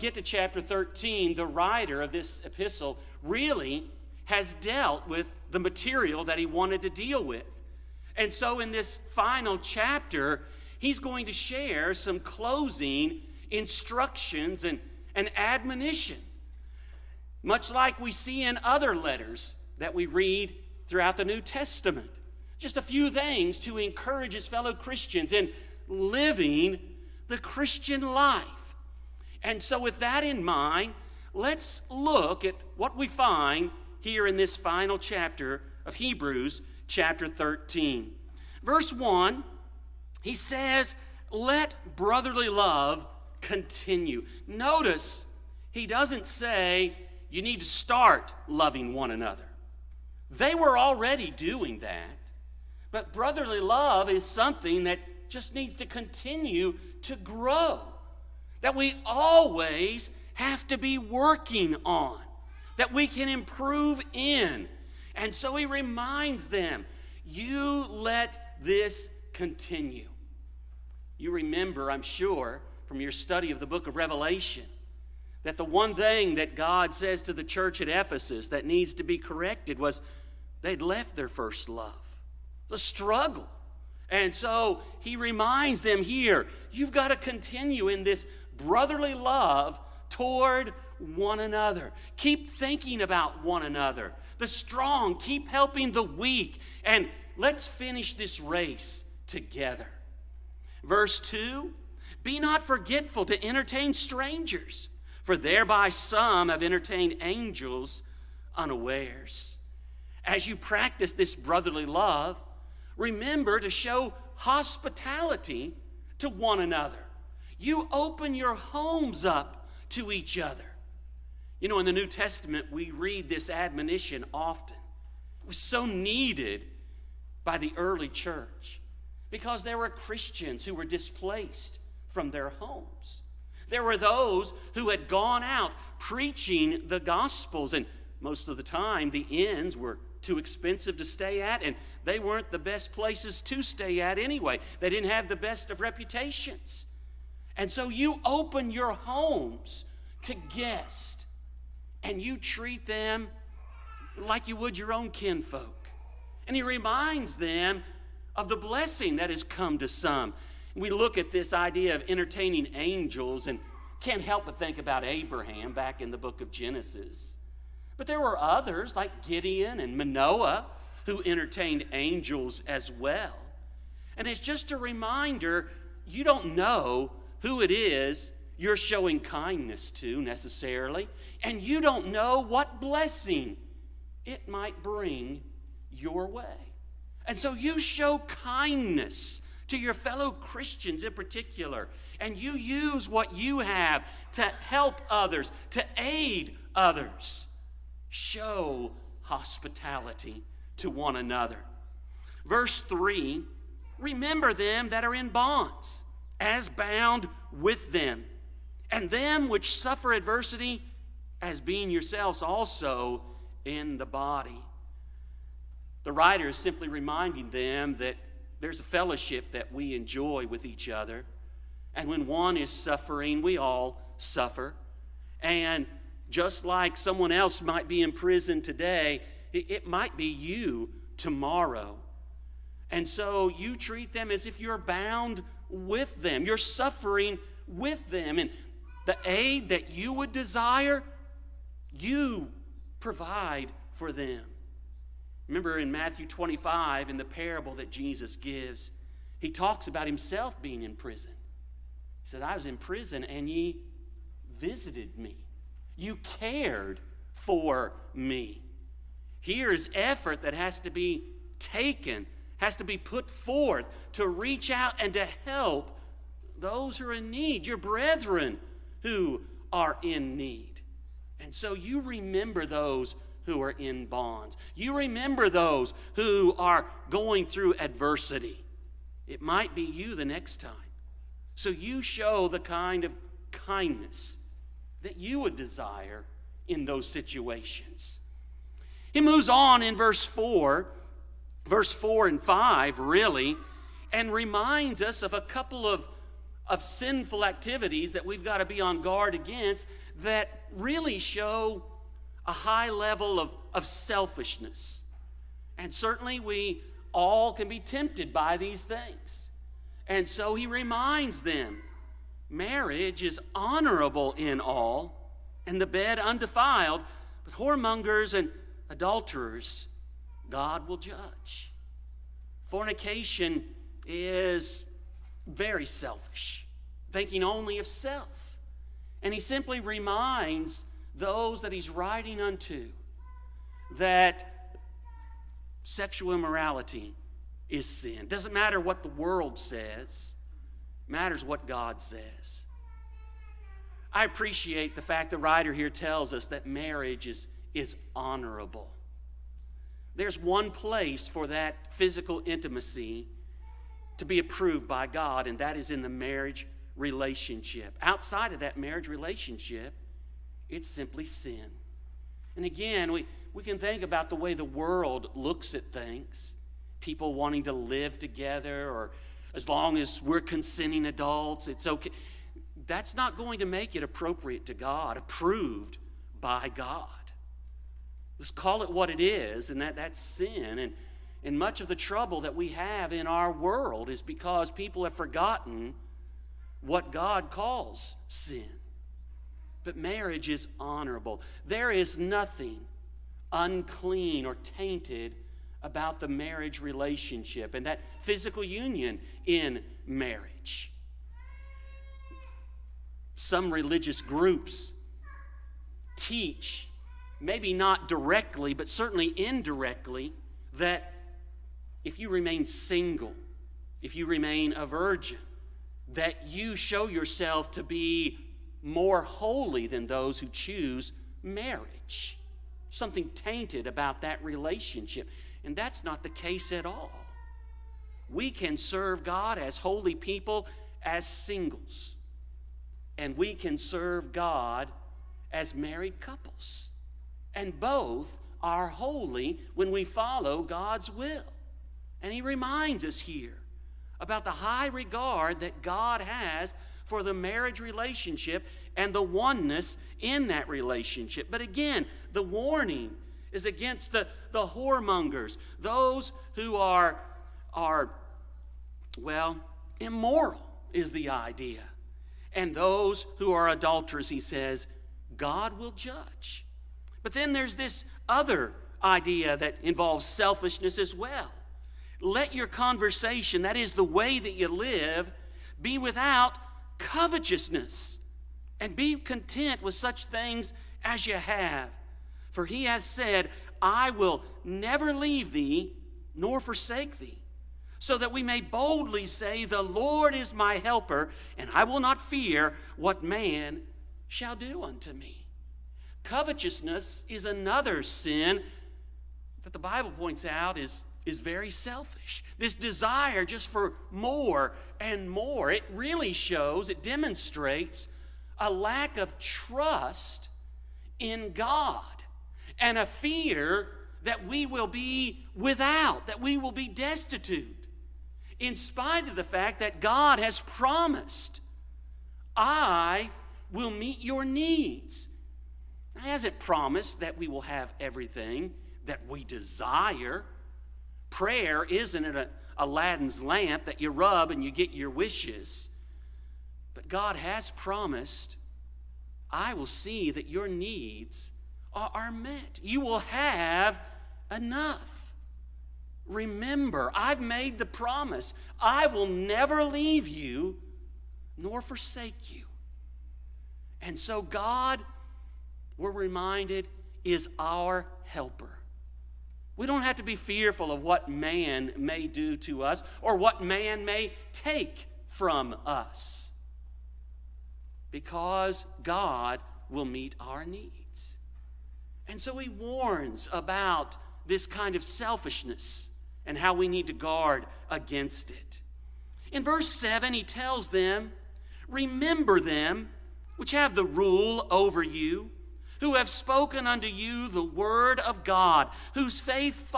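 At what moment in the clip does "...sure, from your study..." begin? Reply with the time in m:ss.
1:12.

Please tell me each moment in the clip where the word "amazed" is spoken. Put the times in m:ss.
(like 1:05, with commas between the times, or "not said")
not said.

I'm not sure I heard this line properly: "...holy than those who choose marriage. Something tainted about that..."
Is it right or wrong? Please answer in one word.
right.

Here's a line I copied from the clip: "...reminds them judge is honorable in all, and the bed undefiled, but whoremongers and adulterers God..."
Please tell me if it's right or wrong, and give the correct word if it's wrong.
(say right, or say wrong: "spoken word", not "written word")
wrong: "marriage", not "judge".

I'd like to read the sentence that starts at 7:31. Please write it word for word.
But again, the warning is against the, the whoremongers, those who are, are, well, immoral is the idea.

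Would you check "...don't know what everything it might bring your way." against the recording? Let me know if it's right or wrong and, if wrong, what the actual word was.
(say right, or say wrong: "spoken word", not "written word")
wrong: "blessing", not "everything".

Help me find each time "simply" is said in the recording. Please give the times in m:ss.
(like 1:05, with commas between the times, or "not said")
3:36, 5:29, 6:00.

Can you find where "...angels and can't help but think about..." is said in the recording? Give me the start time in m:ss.
2:42.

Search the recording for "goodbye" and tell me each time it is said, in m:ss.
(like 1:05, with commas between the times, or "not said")
not said.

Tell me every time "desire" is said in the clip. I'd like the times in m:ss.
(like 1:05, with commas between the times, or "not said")
4:00, 4:45, 8:22, 8:49.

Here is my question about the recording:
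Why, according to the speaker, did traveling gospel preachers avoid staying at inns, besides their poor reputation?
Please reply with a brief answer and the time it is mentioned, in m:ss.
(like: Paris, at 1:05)
too expensive, at 2:20.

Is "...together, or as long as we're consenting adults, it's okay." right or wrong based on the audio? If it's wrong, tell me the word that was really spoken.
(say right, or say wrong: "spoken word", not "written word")
right.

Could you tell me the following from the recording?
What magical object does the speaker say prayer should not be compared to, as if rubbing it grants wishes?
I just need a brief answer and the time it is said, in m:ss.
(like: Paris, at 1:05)
Aladdin's lamp, at 8:52.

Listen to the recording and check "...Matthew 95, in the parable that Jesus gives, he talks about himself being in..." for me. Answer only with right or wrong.
wrong.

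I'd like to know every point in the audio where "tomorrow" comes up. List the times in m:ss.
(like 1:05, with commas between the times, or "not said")
3:51.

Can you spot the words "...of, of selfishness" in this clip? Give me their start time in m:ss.
5:03.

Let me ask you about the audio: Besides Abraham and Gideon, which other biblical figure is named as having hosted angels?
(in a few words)
Manoah.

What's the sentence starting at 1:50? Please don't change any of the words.
As you practice this brotherly love, remember to show hospitality to one another.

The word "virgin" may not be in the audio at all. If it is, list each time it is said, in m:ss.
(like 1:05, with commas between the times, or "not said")
6:54.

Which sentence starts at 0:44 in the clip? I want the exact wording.
Notice he doesn't say you need to start loving one another.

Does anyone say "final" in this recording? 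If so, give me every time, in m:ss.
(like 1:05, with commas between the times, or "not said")
0:09, 0:34.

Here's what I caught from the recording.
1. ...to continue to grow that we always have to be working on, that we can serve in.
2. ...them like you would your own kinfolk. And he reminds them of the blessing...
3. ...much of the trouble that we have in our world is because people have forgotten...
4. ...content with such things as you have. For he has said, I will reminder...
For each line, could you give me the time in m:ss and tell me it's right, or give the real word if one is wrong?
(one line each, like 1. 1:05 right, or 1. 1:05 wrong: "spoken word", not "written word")
1. 0:55 wrong: "improve", not "serve"
2. 2:32 right
3. 6:21 right
4. 7:59 wrong: "never", not "reminder".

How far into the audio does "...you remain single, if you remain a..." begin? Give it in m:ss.
6:52.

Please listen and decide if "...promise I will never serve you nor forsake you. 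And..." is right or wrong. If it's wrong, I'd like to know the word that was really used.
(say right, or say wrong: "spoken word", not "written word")
wrong: "leave", not "serve".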